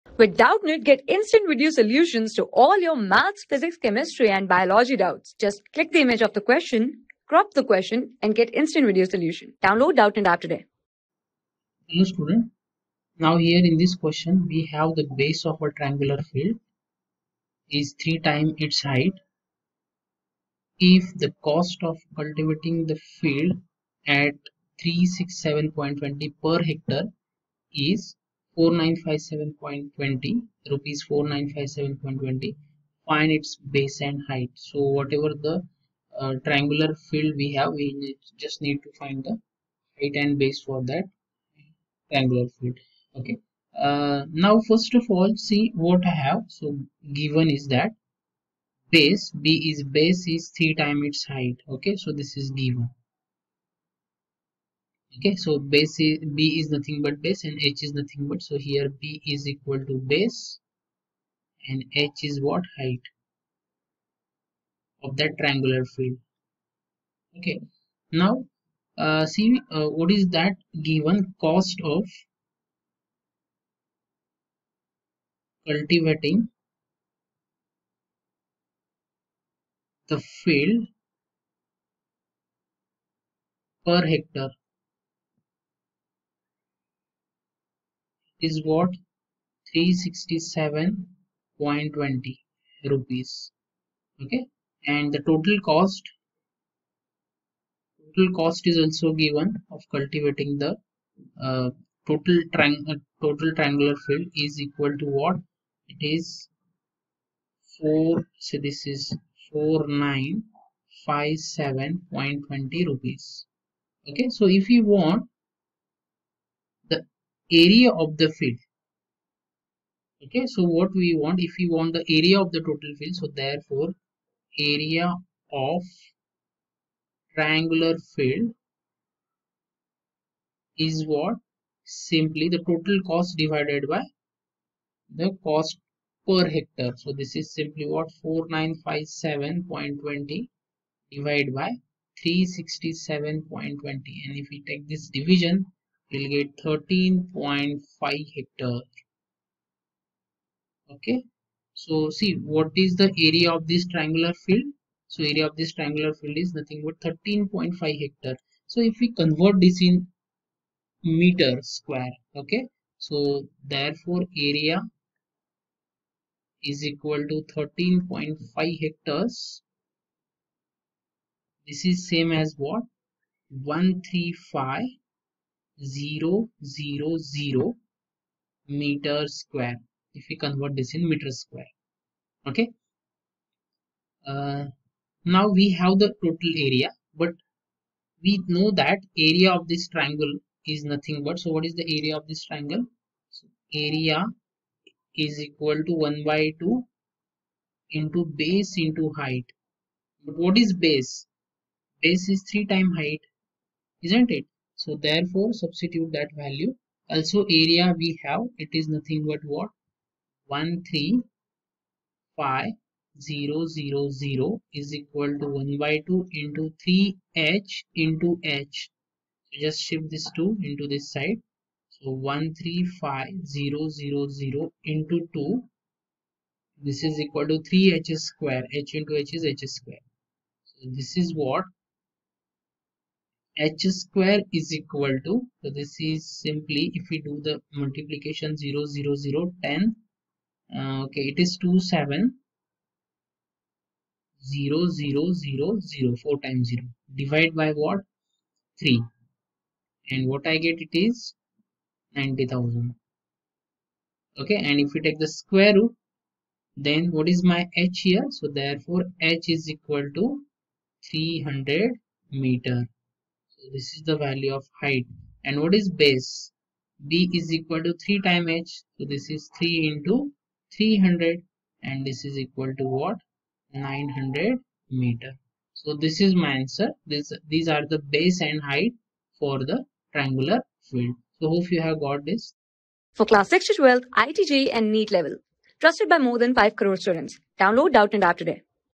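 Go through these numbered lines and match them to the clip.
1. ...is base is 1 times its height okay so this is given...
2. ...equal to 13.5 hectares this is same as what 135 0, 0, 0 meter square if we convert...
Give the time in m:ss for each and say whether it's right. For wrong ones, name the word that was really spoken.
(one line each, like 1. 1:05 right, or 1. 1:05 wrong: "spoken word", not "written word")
1. 0:49 wrong: "3", not "1"
2. 2:46 right.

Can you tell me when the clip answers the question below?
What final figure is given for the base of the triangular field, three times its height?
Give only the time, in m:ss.
4:33.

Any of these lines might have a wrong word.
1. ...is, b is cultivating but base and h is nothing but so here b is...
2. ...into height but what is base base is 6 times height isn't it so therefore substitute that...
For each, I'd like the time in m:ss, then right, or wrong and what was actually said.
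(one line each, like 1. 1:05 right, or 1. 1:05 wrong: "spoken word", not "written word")
1. 0:55 wrong: "nothing", not "cultivating"
2. 3:18 wrong: "3", not "6".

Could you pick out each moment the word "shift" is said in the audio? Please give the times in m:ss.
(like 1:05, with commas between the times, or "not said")
3:39.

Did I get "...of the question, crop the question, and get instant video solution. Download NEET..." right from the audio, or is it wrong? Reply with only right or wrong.
wrong.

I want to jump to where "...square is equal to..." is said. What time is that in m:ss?
3:54.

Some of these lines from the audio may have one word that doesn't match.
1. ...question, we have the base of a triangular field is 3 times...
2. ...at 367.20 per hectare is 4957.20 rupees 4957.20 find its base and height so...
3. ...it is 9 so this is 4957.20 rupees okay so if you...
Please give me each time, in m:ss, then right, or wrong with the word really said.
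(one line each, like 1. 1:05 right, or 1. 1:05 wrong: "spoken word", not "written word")
1. 0:13 right
2. 0:24 right
3. 1:45 wrong: "4", not "9".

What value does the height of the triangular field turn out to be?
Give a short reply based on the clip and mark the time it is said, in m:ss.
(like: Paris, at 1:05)
300 meters, at 4:21.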